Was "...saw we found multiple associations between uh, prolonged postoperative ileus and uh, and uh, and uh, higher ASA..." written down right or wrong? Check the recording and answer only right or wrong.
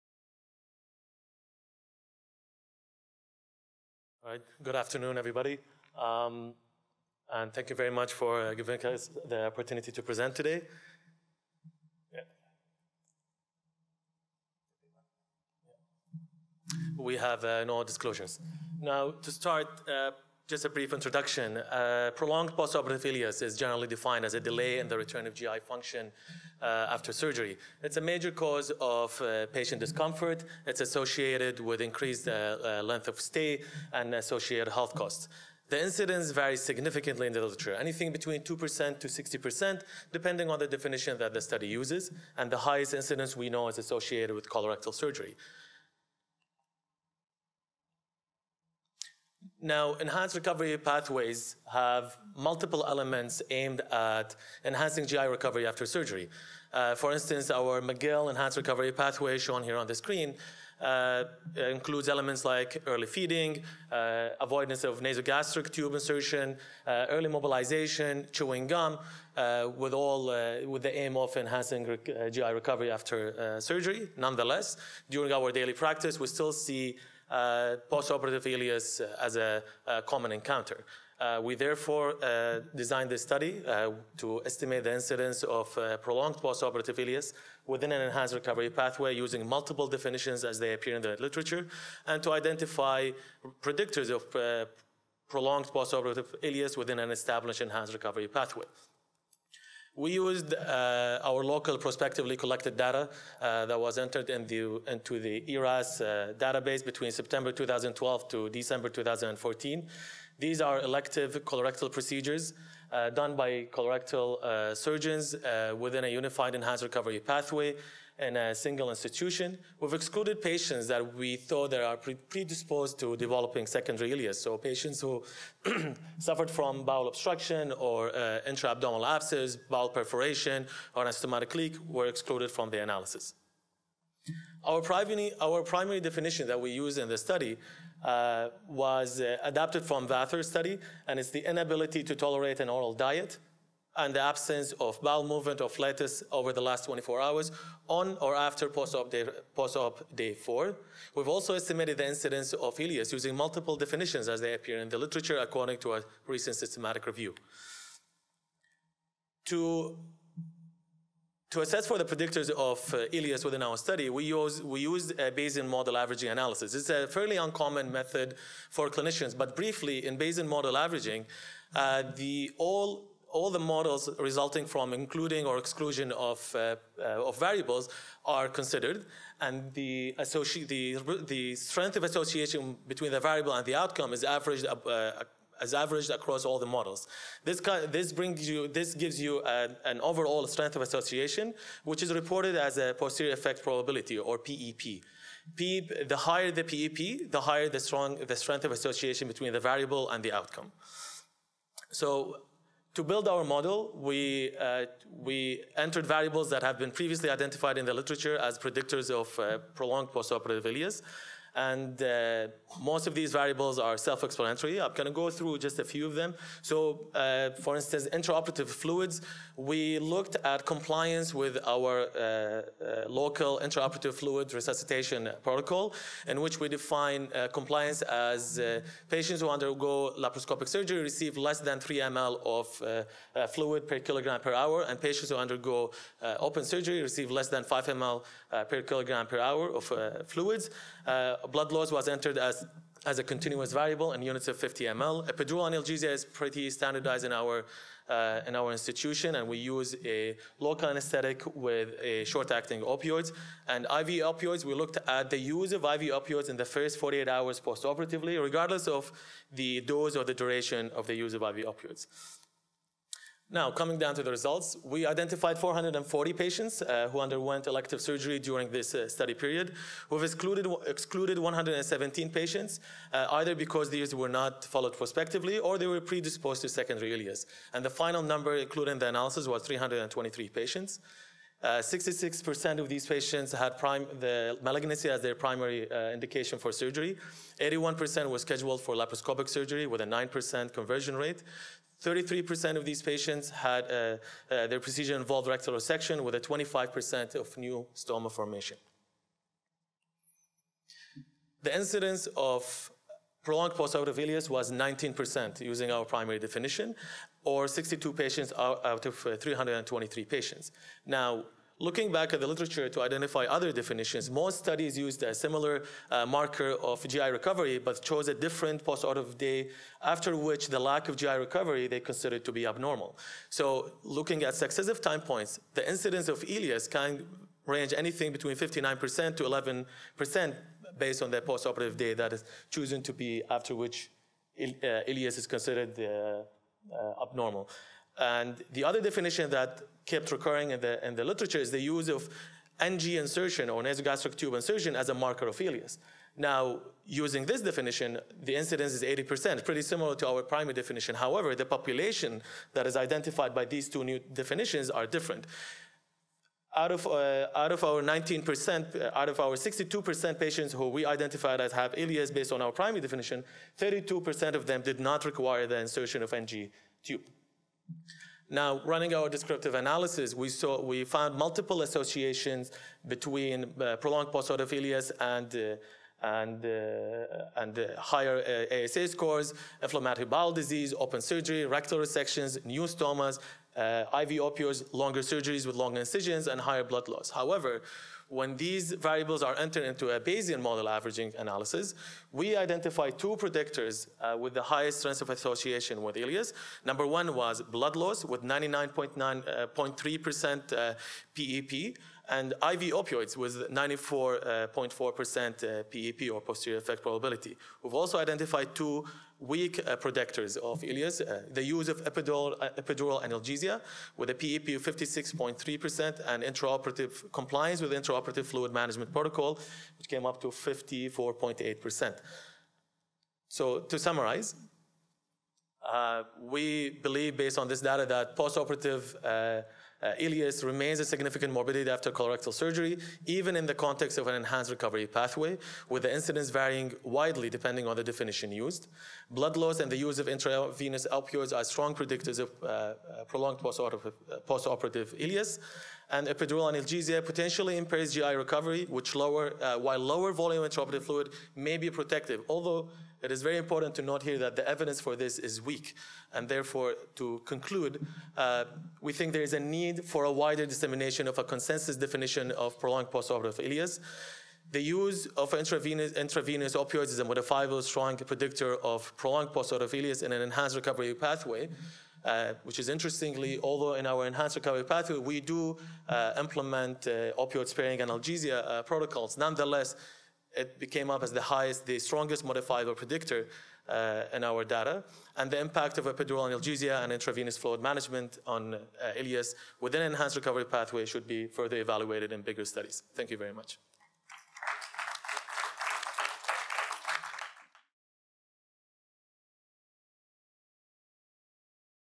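right.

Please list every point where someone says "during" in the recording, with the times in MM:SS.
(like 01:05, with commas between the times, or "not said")
01:15, 04:28.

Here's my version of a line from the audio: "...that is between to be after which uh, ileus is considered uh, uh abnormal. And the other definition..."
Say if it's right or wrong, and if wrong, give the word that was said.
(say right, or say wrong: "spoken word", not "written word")
wrong: "chosen", not "between".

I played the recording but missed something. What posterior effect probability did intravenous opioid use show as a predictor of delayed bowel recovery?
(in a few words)
94.4%.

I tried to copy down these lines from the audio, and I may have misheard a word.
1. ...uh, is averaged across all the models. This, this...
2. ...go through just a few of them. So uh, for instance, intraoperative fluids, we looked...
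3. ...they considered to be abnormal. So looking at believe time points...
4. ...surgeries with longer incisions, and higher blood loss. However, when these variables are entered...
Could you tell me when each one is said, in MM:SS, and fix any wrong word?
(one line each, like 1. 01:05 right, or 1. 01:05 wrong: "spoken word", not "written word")
1. 03:04 right
2. 03:35 right
3. 05:21 wrong: "successive", not "believe"
4. 06:25 right.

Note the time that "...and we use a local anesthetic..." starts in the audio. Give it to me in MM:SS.
04:09.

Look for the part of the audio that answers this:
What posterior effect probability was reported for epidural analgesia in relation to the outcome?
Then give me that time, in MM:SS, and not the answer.
06:54.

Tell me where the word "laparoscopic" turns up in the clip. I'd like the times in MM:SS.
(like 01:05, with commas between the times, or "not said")
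03:50, 04:48.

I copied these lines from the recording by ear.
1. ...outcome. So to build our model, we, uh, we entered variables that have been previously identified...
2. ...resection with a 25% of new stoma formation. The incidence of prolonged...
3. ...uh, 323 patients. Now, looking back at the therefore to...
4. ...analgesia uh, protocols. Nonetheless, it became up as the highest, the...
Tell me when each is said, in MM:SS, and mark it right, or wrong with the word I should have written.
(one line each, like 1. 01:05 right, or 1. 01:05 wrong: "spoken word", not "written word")
1. 03:20 right
2. 04:55 right
3. 05:09 wrong: "literature", not "therefore"
4. 07:57 right.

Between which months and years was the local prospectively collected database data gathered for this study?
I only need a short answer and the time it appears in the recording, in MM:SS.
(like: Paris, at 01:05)
September 2012 to December 2014, at 01:47.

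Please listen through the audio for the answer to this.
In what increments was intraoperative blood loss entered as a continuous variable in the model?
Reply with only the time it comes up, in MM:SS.
04:04.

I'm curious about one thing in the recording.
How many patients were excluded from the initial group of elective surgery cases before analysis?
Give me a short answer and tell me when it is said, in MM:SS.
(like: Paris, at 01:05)
117, at 04:31.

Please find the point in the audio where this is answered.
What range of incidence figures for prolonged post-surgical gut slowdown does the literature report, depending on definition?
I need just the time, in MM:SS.
00:38.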